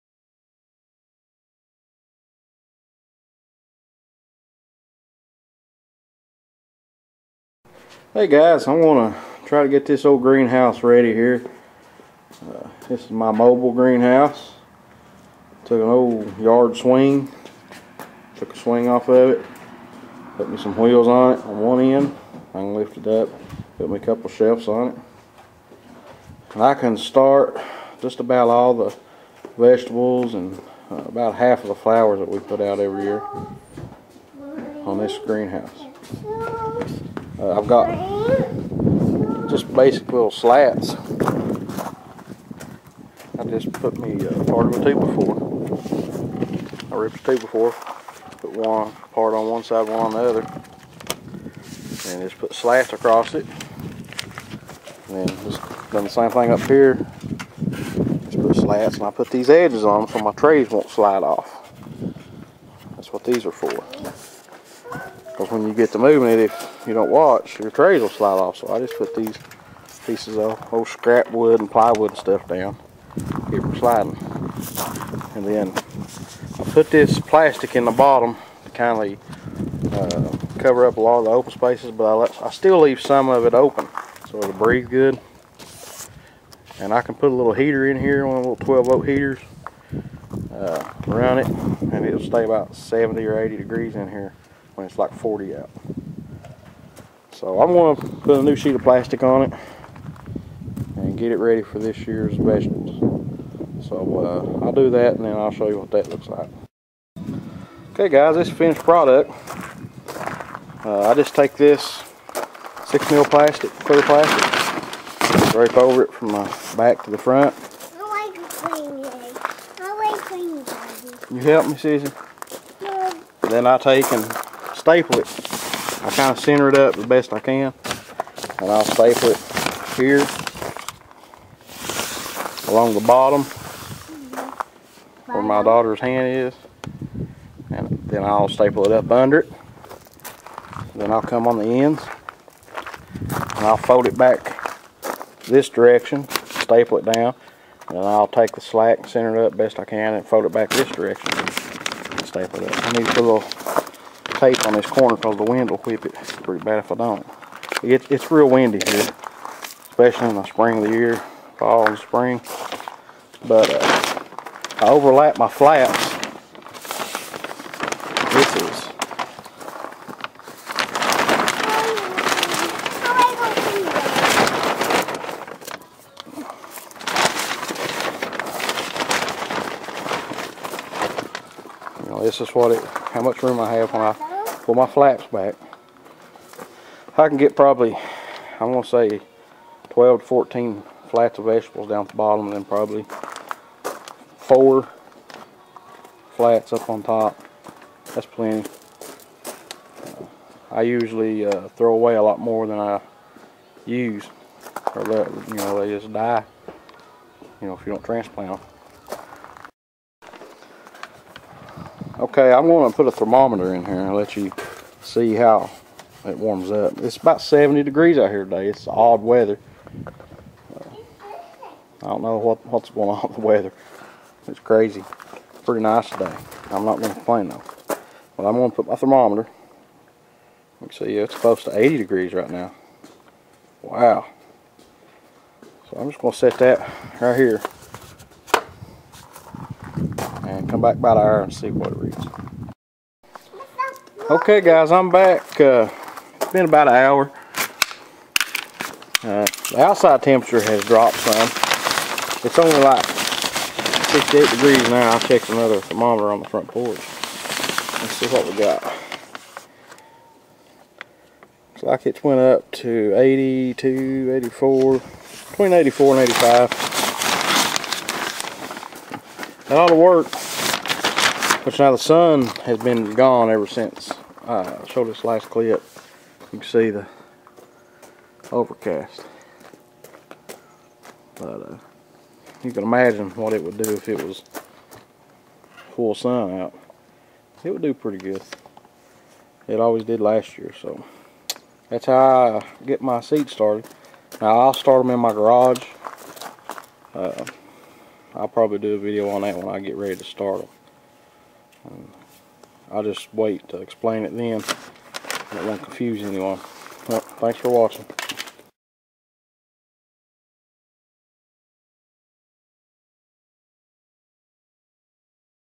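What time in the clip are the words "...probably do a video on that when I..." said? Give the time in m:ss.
4:58.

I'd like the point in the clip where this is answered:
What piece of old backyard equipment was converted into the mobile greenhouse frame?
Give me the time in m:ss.
0:16.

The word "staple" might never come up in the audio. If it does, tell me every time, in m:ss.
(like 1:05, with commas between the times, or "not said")
2:04, 2:08, 2:18, 2:26, 2:32.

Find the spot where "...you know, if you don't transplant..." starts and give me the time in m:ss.
3:27.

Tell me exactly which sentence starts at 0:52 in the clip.
And just put slats across it.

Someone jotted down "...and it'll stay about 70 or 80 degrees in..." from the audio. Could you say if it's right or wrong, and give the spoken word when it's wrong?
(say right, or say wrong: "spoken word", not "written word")
right.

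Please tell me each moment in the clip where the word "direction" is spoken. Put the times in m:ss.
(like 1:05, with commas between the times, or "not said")
2:25, 2:30.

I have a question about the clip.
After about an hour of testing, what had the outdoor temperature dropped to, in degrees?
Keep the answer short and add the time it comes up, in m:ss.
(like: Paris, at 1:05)
68, at 4:14.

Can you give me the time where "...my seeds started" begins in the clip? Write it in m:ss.
4:53.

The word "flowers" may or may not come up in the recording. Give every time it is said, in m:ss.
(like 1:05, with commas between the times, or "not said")
0:31.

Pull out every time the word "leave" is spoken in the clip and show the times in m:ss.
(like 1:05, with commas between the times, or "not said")
1:22.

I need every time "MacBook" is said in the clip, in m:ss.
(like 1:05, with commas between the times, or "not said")
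not said.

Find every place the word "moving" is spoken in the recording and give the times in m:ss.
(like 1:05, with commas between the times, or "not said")
1:05.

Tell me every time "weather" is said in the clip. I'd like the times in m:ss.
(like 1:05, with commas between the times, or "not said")
3:39, 3:43.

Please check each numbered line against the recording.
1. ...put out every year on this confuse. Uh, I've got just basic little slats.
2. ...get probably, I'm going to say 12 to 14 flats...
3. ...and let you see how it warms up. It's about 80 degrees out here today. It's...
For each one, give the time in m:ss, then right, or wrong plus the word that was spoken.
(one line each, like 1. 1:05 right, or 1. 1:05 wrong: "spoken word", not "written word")
1. 0:32 wrong: "greenhouse", not "confuse"
2. 3:07 right
3. 3:33 wrong: "70", not "80".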